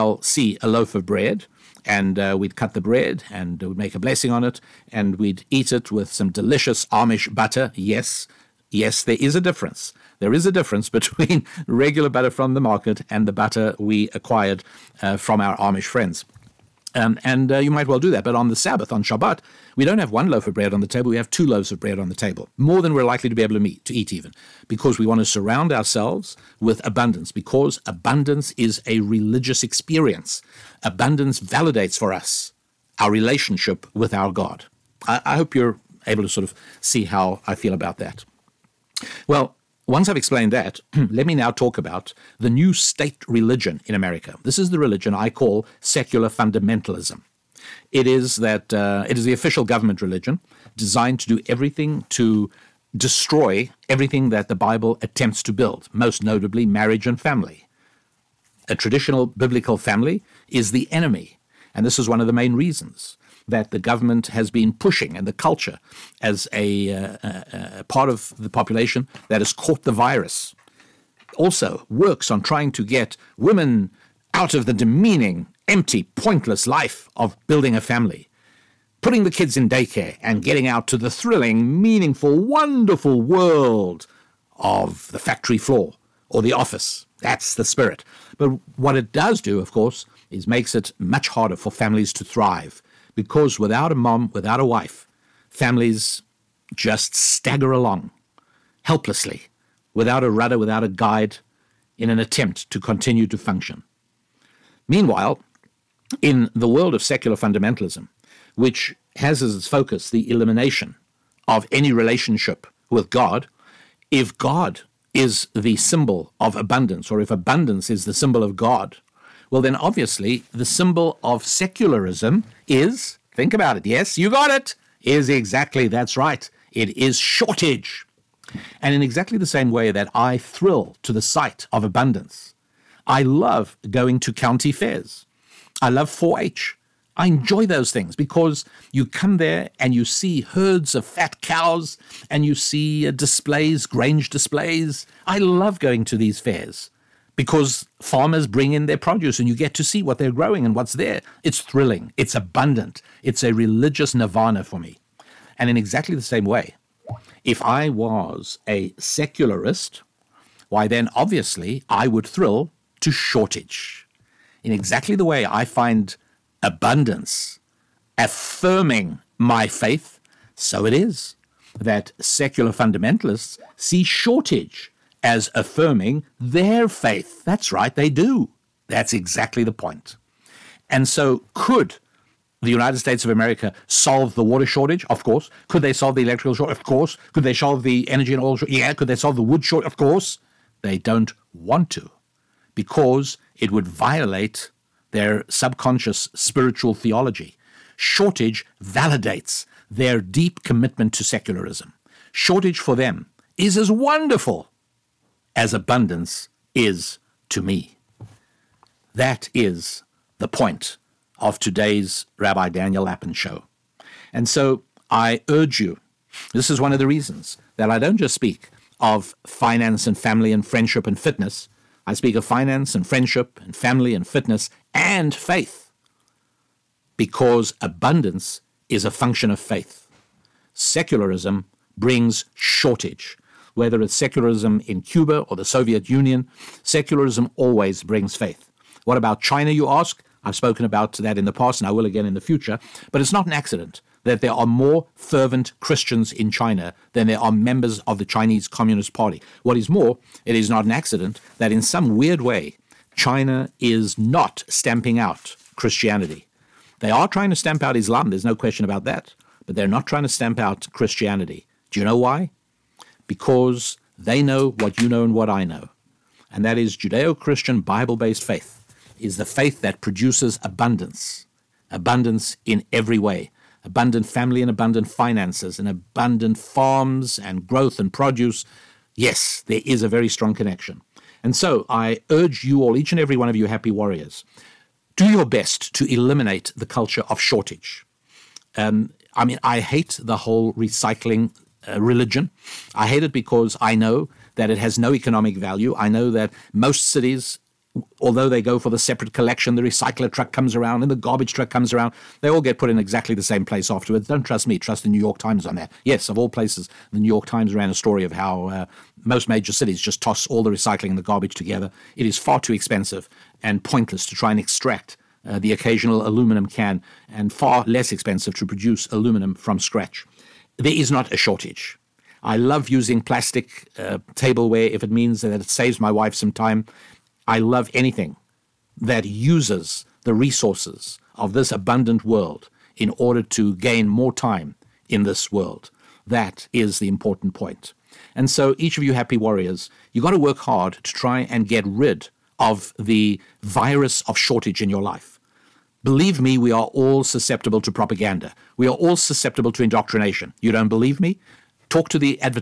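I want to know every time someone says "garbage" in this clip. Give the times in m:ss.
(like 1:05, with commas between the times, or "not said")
5:01, 5:11.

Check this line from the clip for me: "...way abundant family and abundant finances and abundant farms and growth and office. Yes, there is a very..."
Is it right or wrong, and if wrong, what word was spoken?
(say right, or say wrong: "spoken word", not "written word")
wrong: "produce", not "office".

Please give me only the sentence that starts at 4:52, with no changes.
I hate it because I know that it has no economic value.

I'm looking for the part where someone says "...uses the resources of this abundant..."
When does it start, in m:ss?
5:29.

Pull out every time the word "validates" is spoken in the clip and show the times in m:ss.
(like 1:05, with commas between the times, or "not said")
0:31, 3:18.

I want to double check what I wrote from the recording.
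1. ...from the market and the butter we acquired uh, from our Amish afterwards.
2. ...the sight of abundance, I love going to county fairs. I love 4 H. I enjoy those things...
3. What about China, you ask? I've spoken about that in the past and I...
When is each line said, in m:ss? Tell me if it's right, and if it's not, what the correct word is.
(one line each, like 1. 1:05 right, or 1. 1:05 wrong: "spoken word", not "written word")
1. 0:12 wrong: "friends", not "afterwards"
2. 2:11 right
3. 3:59 right.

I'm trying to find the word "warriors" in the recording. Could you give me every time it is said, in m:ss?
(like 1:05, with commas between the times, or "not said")
4:43, 5:39.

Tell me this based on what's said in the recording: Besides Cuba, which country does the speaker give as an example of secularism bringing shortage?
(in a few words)
the Soviet Union.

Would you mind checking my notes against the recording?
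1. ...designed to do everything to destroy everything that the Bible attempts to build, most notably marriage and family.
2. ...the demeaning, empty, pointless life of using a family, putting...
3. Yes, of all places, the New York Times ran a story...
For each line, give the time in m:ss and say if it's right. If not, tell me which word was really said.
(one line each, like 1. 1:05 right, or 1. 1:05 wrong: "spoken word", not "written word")
1. 0:50 right
2. 1:14 wrong: "building", not "using"
3. 5:06 right.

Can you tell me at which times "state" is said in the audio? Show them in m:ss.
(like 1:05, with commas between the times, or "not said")
0:42, 3:02.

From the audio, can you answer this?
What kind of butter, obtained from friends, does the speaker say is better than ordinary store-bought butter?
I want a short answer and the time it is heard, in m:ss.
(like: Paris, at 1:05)
Amish butter, at 0:06.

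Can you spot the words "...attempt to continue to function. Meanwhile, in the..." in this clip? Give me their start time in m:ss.
1:42.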